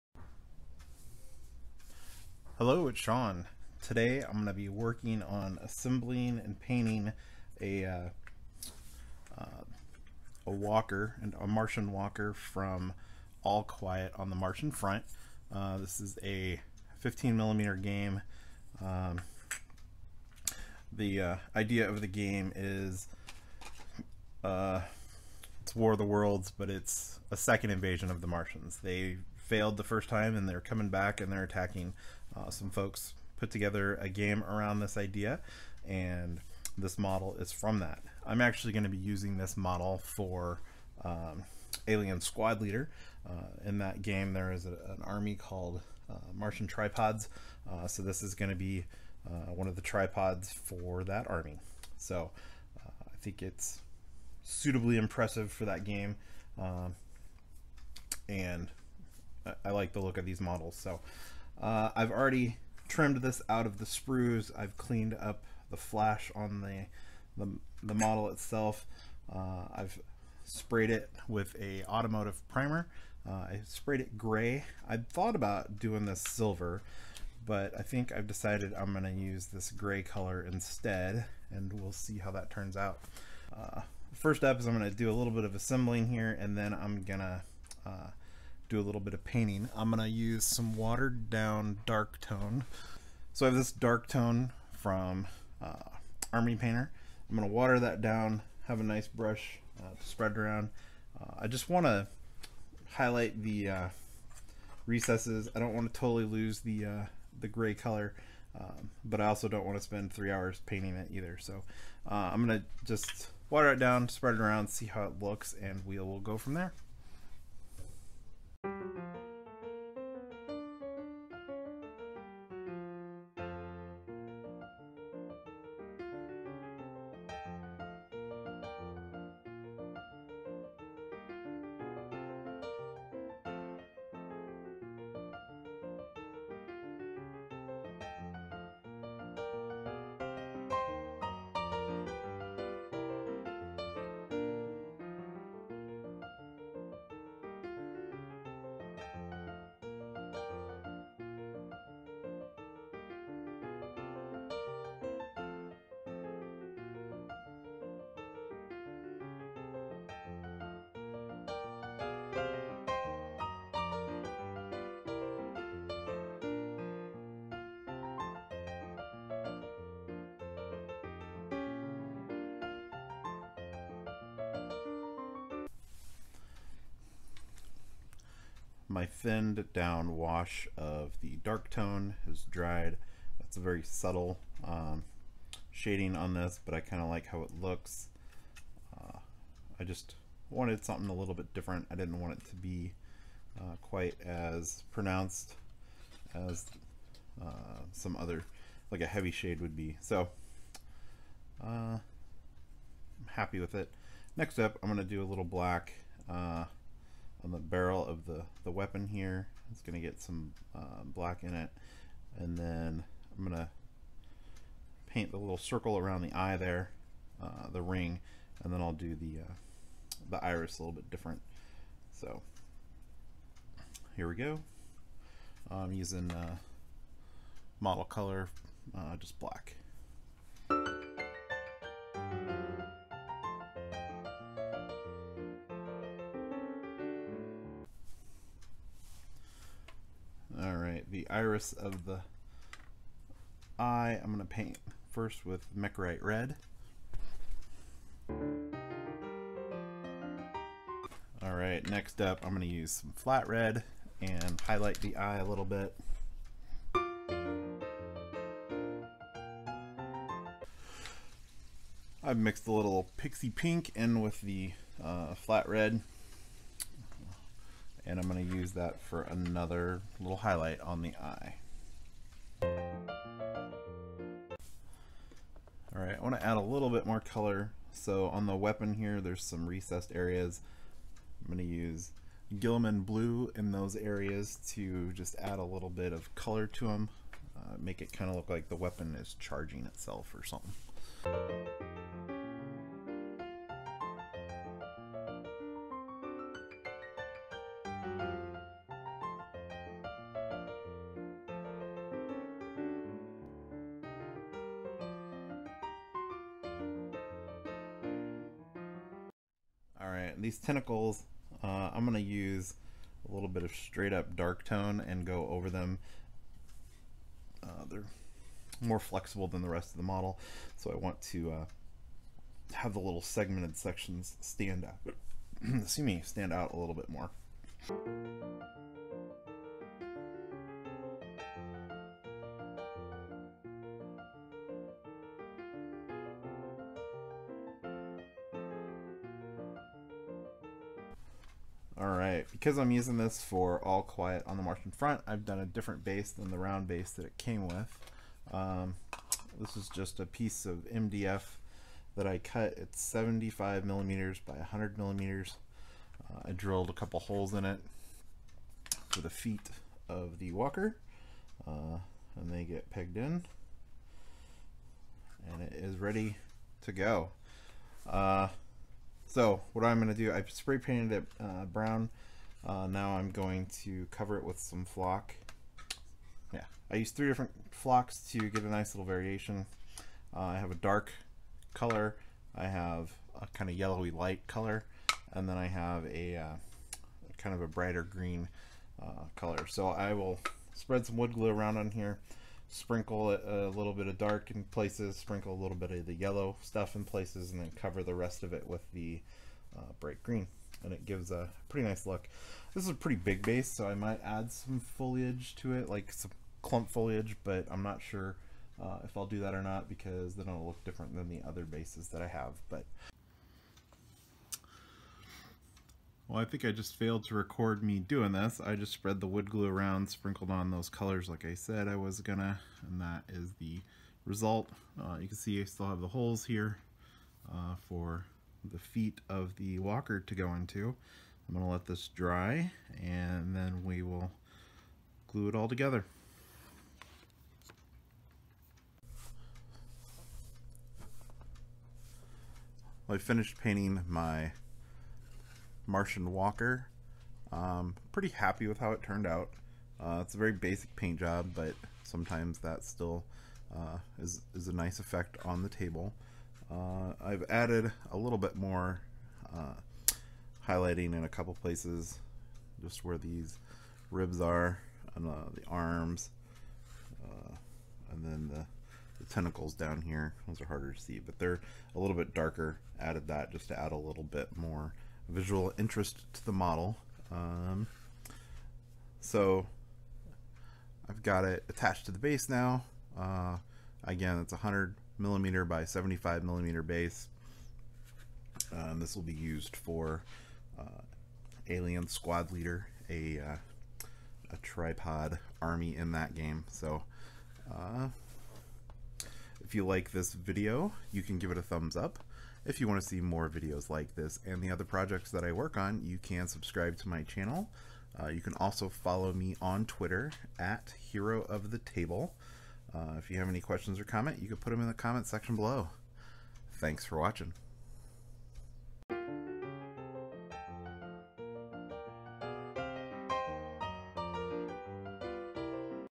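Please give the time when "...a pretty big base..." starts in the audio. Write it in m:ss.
6:42.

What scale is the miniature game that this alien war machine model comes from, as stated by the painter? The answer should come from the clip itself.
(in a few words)
15mm.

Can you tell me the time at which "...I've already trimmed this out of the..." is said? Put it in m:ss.
1:01.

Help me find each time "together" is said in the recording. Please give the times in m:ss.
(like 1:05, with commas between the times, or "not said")
0:33, 7:15.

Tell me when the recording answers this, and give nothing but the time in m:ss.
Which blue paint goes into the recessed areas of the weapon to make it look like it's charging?
4:42.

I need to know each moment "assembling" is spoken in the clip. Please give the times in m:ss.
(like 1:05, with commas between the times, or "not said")
0:05, 1:25.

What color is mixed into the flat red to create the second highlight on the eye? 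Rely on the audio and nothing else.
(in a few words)
Pixie pink.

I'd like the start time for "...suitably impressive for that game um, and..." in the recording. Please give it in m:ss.
0:54.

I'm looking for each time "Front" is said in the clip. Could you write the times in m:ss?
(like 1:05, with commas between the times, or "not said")
0:14, 5:44.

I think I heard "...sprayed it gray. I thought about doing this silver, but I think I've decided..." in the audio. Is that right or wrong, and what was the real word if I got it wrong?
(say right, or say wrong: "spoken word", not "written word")
right.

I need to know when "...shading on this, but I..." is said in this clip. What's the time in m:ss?
3:05.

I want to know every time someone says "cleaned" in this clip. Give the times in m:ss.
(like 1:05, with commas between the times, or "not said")
1:04.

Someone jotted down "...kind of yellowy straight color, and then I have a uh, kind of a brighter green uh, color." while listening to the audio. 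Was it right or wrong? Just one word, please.
wrong.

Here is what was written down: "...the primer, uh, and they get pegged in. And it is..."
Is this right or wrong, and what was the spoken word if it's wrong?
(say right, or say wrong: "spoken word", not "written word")
wrong: "walker", not "primer".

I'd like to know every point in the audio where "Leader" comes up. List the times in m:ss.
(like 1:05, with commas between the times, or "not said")
0:42, 8:12.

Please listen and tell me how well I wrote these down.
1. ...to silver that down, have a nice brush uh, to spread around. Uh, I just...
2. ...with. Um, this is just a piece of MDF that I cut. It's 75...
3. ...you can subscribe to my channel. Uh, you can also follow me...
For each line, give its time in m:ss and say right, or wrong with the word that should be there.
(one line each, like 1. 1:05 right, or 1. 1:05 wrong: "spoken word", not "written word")
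1. 1:37 wrong: "water", not "silver"
2. 5:47 right
3. 8:26 right.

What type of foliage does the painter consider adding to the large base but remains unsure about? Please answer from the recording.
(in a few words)
Clump foliage.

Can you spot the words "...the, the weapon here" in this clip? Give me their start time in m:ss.
3:28.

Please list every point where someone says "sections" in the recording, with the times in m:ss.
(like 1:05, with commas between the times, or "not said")
5:23, 8:35.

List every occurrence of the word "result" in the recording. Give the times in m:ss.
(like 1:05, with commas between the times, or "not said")
7:04.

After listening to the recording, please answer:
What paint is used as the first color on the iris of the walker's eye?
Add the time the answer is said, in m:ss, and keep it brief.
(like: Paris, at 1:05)
Mechrite Red, at 4:05.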